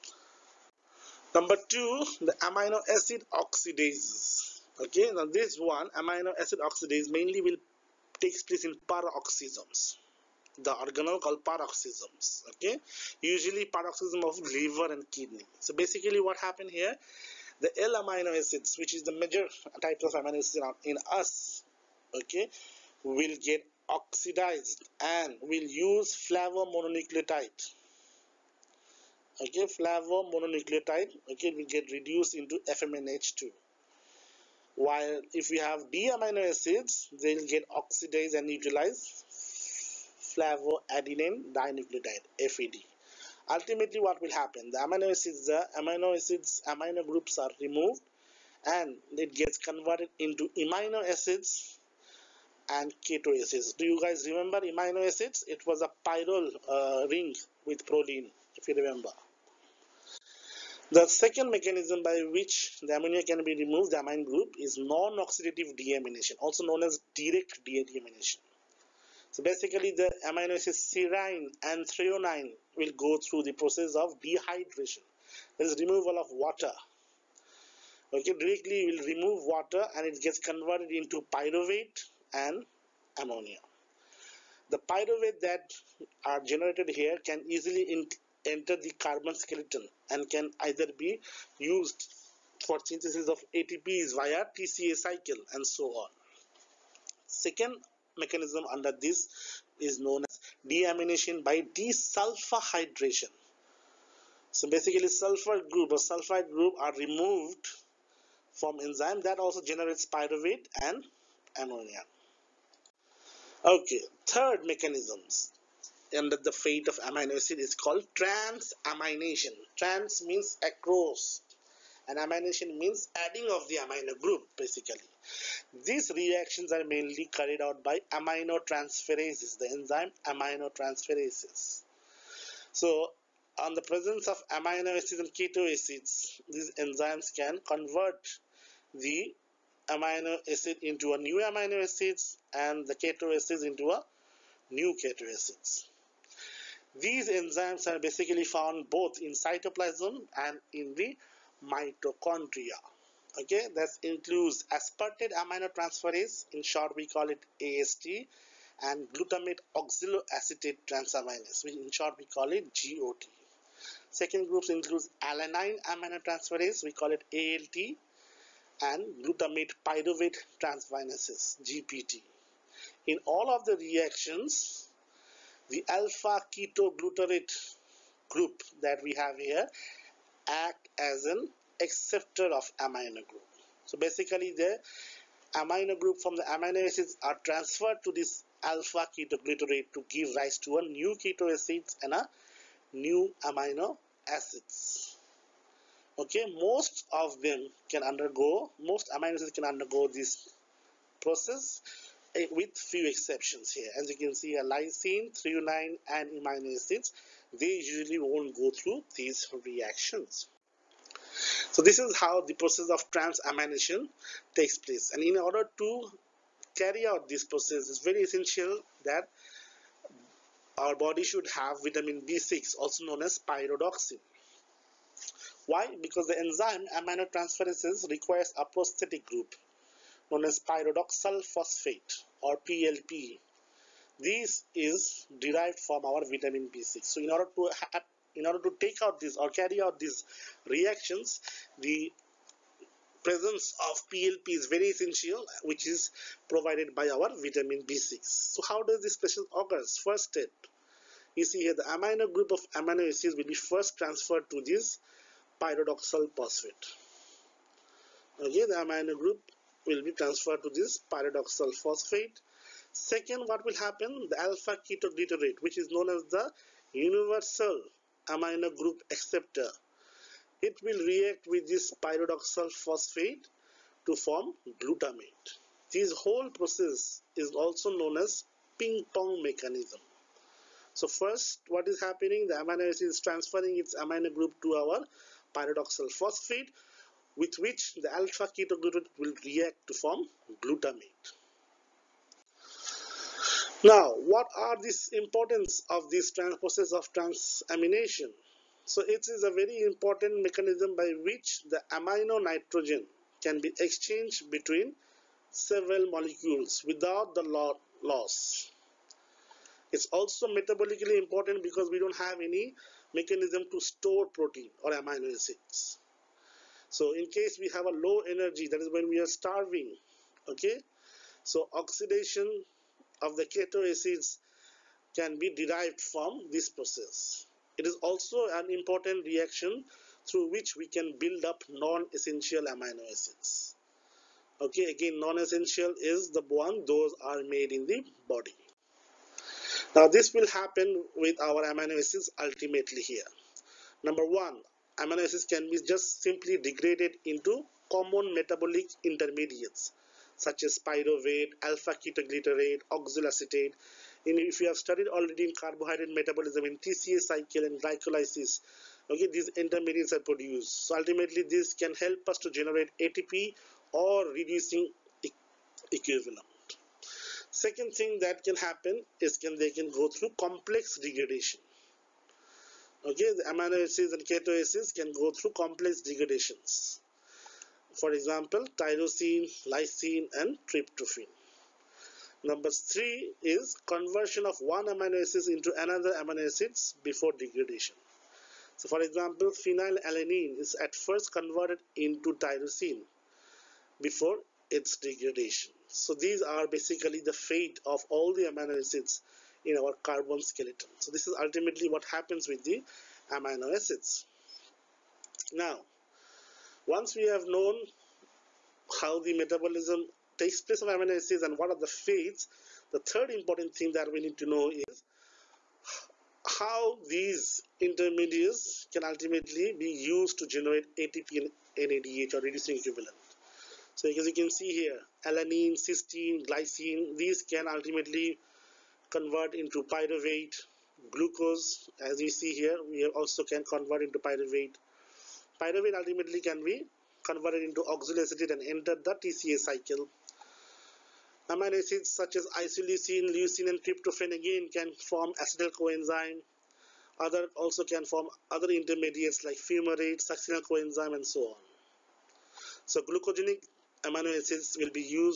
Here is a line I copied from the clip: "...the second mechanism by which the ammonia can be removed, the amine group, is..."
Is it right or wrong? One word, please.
right.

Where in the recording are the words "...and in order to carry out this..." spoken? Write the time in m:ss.
3:35.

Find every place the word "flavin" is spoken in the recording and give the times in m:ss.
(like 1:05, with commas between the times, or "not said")
0:26, 0:40.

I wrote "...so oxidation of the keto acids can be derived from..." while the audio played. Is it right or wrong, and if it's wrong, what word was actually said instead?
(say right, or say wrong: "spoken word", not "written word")
right.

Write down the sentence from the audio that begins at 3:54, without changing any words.
This is derived from our vitamin B6.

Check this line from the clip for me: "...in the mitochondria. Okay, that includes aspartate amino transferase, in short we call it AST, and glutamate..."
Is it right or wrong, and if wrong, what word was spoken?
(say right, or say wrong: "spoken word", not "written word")
right.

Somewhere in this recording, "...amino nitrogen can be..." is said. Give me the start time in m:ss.
5:01.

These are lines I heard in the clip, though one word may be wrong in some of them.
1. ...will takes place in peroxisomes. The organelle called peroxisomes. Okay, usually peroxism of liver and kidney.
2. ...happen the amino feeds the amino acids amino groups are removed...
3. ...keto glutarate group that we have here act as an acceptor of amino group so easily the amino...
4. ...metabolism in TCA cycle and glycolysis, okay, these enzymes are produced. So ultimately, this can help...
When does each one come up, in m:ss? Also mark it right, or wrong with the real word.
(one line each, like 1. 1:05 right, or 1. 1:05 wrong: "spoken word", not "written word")
1. 0:07 right
2. 0:44 wrong: "acids", not "feeds"
3. 2:56 wrong: "basically", not "easily"
4. 5:56 wrong: "intermediates", not "enzymes".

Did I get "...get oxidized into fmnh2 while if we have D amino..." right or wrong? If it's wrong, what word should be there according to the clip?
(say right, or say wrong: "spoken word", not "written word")
wrong: "reduced", not "oxidized".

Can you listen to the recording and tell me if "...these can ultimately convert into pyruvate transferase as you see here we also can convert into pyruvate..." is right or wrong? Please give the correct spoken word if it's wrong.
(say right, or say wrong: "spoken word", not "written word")
wrong: "glucose", not "transferase".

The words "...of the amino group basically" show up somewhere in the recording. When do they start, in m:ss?
2:03.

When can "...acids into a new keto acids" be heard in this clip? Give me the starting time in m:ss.
2:23.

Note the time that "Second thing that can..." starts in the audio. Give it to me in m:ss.
6:07.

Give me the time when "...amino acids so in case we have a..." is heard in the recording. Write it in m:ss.
5:14.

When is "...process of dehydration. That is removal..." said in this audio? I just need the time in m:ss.
1:13.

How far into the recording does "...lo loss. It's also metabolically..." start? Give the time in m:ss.
5:07.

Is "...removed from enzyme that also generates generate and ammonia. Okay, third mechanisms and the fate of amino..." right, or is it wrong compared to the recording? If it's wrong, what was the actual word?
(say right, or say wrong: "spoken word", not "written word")
wrong: "pyruvate", not "generate".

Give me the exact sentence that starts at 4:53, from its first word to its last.
Now, what are the importance of this process of transamination?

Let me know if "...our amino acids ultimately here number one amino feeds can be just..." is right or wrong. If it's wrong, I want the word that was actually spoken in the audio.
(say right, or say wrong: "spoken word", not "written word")
wrong: "acids", not "feeds".